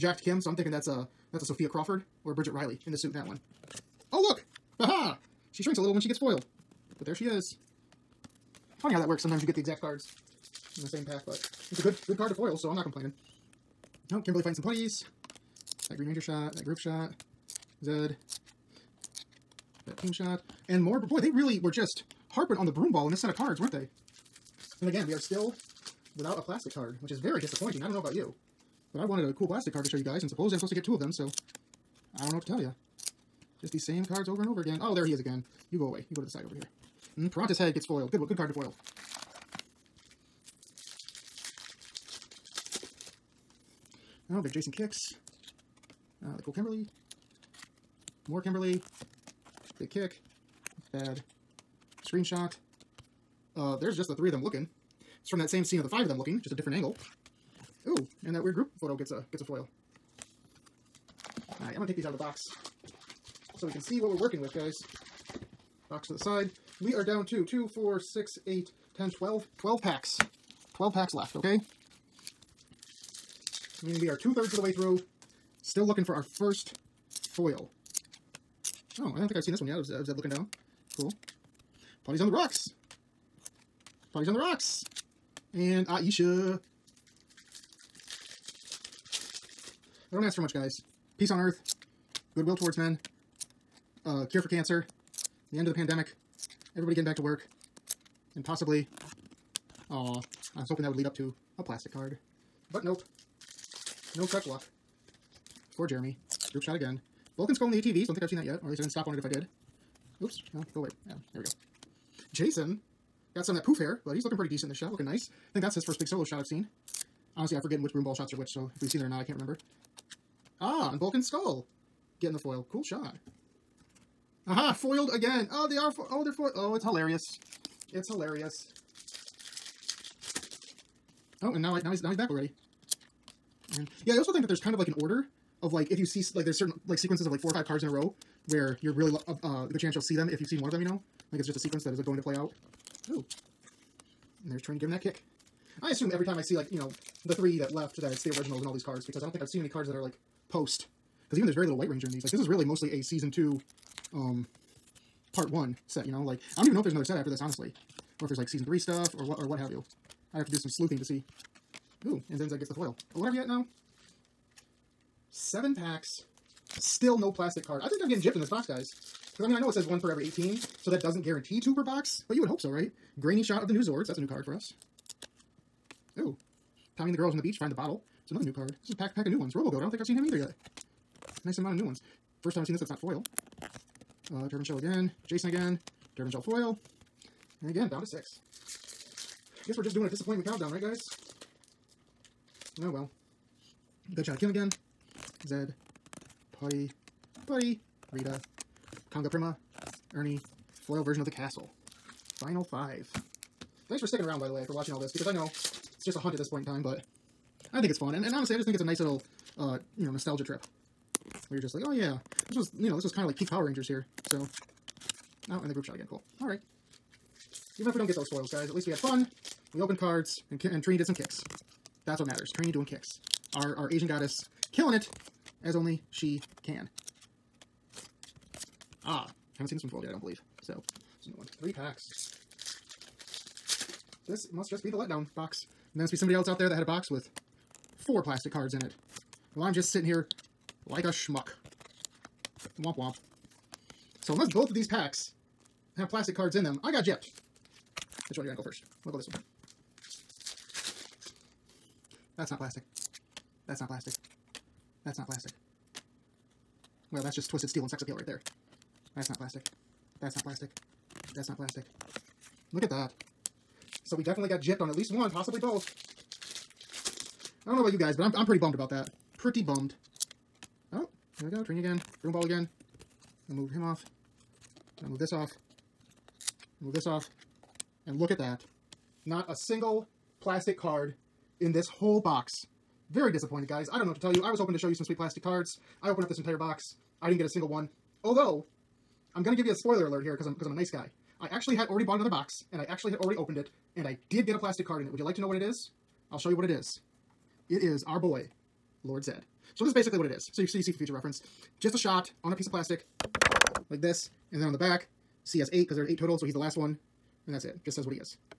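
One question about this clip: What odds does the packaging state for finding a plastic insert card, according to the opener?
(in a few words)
one per every 18.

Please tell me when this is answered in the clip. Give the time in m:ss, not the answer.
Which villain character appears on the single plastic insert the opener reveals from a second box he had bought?
4:59.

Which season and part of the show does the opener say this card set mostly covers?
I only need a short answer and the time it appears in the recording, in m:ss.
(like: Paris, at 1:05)
Season 2, Part 1, at 2:33.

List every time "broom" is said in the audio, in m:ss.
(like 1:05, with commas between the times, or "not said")
0:22, 1:57, 4:32.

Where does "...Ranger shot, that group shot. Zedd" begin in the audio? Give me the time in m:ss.
0:16.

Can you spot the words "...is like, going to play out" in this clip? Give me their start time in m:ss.
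2:21.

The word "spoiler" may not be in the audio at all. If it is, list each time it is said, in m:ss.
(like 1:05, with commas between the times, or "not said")
4:49.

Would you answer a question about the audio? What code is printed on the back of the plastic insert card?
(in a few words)
CS8.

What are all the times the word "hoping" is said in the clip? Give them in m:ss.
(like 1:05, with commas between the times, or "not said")
1:40, 4:44.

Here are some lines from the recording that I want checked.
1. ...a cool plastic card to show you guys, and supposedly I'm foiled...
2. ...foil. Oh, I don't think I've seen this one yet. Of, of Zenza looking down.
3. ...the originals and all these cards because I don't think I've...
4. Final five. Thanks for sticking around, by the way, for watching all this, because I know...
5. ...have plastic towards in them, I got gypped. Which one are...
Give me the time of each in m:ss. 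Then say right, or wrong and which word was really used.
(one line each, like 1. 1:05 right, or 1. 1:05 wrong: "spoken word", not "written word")
1. 0:29 wrong: "supposed", not "foiled"
2. 1:17 wrong: "Zedd", not "Zenza"
3. 2:28 right
4. 3:22 right
5. 4:05 wrong: "cards", not "towards".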